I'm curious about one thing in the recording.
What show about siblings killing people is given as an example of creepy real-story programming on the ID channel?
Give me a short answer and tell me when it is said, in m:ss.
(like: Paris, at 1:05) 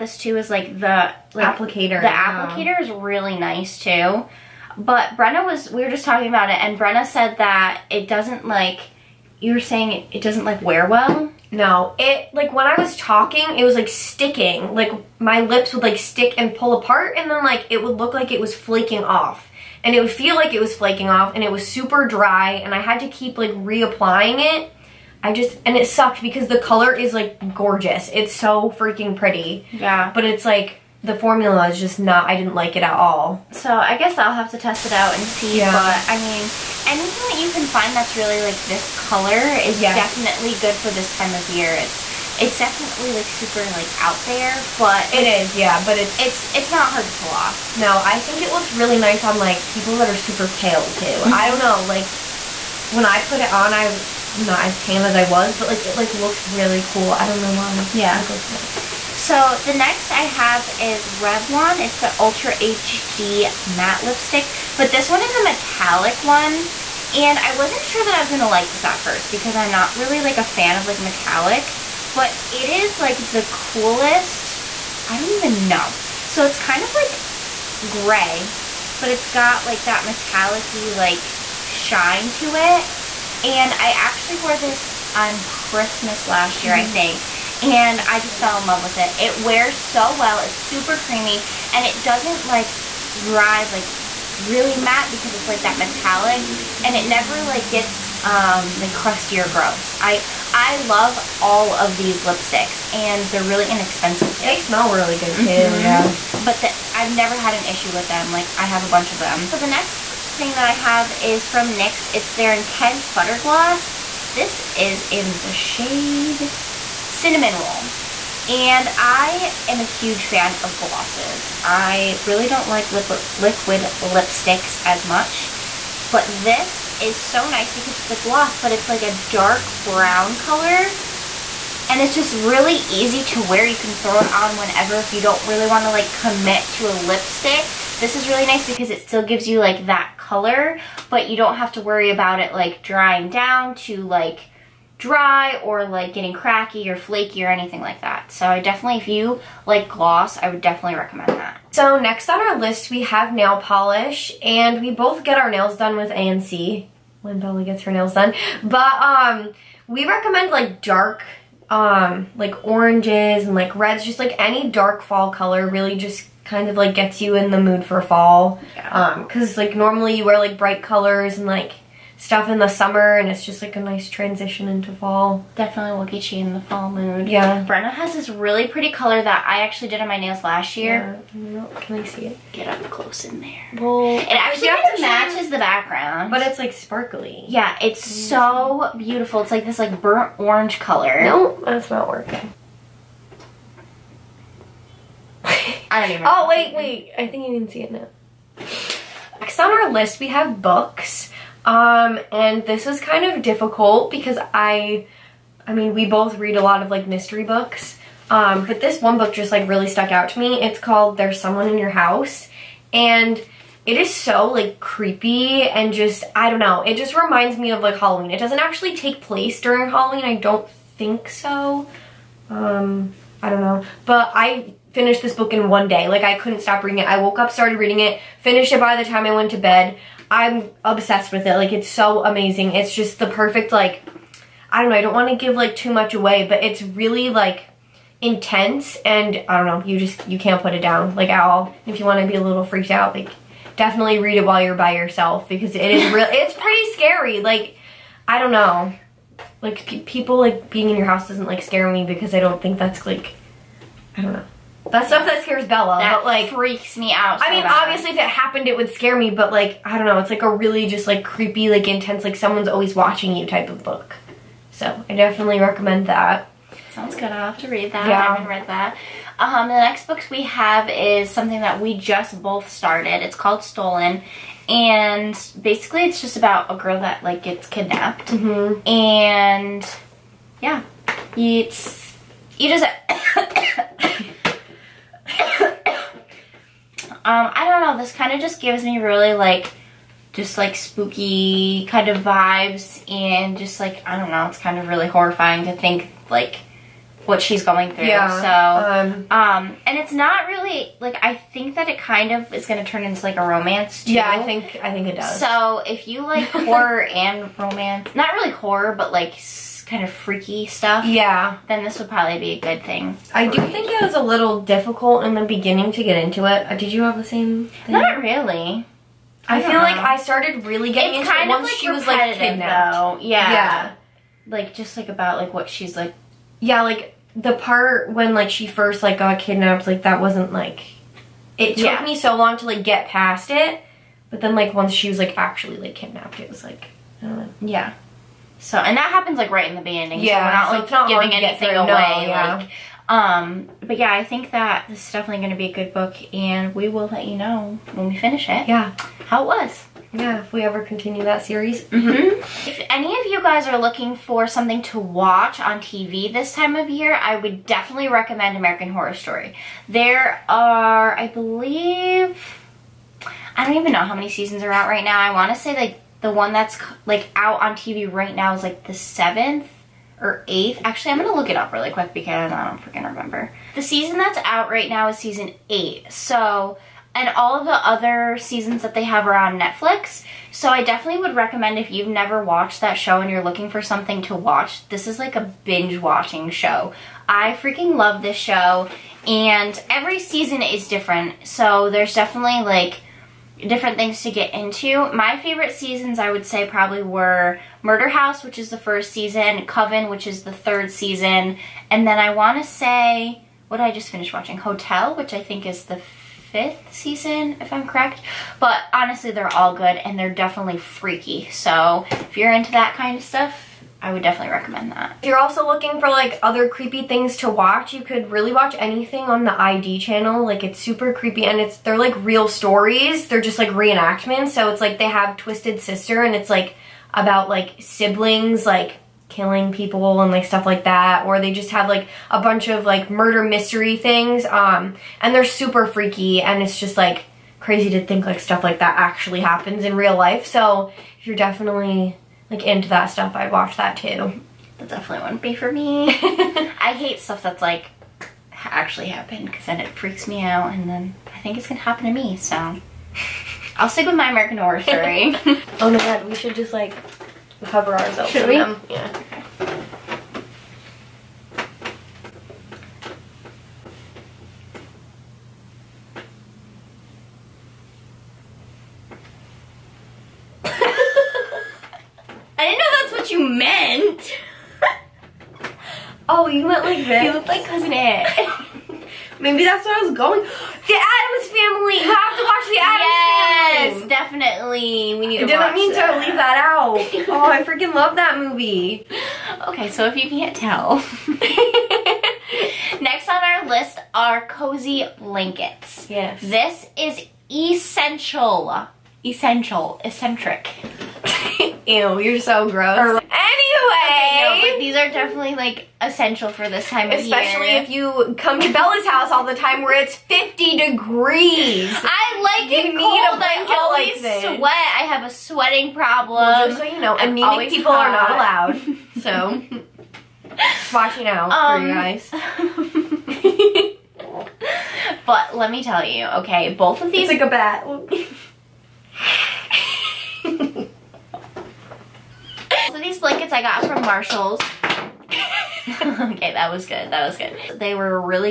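Twisted Sister, at 7:05.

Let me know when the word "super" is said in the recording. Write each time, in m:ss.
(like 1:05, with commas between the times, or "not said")
0:21, 0:43, 0:50, 1:30, 7:00, 7:15.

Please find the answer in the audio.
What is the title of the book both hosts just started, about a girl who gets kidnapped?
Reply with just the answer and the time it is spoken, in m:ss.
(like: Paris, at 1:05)
Stolen, at 4:33.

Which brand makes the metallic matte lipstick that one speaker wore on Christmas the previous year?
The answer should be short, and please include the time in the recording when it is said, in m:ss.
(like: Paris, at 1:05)
Revlon, at 1:01.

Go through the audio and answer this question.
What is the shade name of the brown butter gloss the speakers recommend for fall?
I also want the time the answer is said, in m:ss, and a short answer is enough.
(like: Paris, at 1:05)
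Cinnamon Roll, at 1:57.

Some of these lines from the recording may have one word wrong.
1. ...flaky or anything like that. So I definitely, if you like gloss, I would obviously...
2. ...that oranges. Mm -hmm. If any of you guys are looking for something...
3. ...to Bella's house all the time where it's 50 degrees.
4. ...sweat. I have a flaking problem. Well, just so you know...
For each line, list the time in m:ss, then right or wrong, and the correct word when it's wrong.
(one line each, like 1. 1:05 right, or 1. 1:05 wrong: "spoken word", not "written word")
1. 2:26 wrong: "definitely", not "obviously"
2. 5:51 wrong: "series", not "oranges"
3. 8:28 right
4. 8:34 wrong: "sweating", not "flaking".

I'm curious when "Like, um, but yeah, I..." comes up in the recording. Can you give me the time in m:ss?
5:42.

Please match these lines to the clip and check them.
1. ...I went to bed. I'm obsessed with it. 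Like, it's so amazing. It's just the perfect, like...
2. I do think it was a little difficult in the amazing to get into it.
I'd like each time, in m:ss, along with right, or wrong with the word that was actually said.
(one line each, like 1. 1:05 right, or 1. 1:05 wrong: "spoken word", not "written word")
1. 3:49 right
2. 5:13 wrong: "beginning", not "amazing".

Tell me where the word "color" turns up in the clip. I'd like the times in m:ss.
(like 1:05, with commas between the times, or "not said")
0:26, 0:38, 2:10, 2:20, 2:45, 2:50, 2:58, 3:10.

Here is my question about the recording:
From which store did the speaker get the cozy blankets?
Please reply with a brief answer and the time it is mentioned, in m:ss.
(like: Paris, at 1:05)
Marshall's, at 8:54.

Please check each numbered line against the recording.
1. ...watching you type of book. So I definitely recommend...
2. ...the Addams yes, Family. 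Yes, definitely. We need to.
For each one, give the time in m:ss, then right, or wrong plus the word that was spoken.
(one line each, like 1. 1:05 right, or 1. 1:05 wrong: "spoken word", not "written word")
1. 4:22 right
2. 8:02 right.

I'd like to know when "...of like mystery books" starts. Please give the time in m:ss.
3:26.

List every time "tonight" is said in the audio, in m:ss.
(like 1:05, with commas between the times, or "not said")
not said.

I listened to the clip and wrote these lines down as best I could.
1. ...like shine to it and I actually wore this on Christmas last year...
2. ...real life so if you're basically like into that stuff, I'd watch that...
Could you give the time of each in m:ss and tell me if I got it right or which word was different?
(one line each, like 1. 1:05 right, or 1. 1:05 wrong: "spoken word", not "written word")
1. 1:20 right
2. 7:19 wrong: "definitely", not "basically".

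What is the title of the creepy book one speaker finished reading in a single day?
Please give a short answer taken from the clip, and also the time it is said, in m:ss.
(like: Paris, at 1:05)
There's Someone in Your House, at 3:31.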